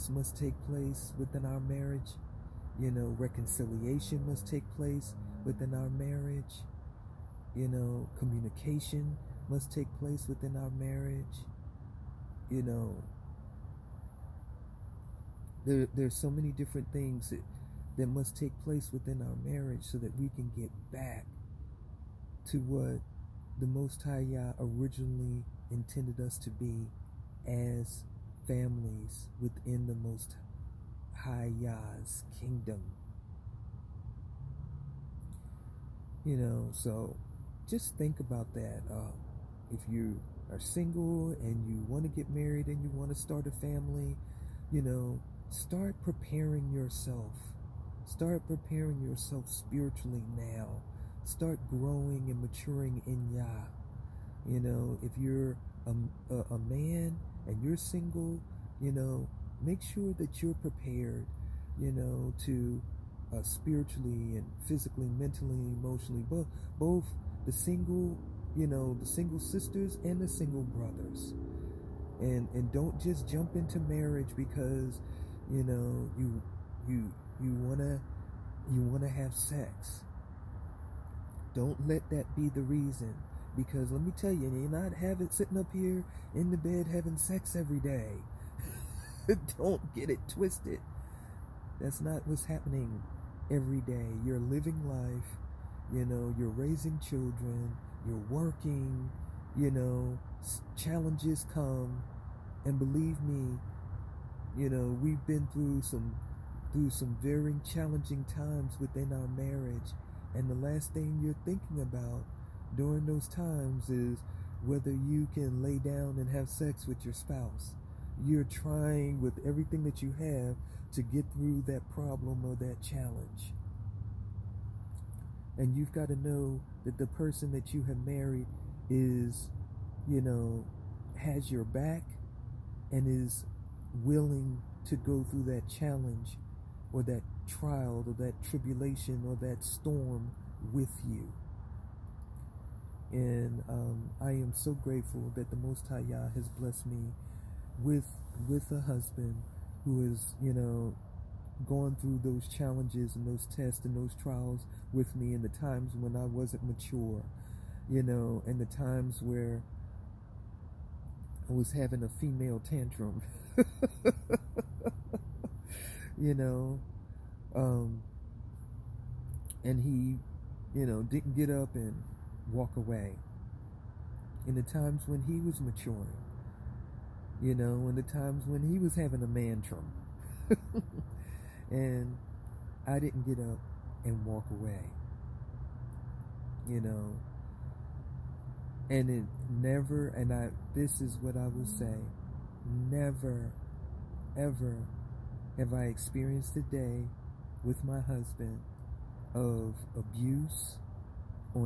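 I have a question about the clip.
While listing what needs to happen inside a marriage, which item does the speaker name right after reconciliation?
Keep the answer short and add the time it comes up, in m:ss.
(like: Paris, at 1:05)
Communication, at 0:08.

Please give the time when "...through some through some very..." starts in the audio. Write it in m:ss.
1:45.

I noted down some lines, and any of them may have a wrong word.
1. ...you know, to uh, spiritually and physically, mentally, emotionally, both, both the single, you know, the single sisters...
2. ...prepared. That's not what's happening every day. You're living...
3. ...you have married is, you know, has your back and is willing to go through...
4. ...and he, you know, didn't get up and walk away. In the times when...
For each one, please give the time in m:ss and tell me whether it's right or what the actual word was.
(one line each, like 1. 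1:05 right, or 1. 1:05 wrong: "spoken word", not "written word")
1. 1:01 right
2. 1:30 wrong: "twisted", not "prepared"
3. 2:07 right
4. 2:49 right.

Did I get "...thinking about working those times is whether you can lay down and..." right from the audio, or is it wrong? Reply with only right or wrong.
wrong.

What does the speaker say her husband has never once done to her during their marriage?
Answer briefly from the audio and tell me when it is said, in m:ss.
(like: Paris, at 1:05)
Abuse, at 3:19.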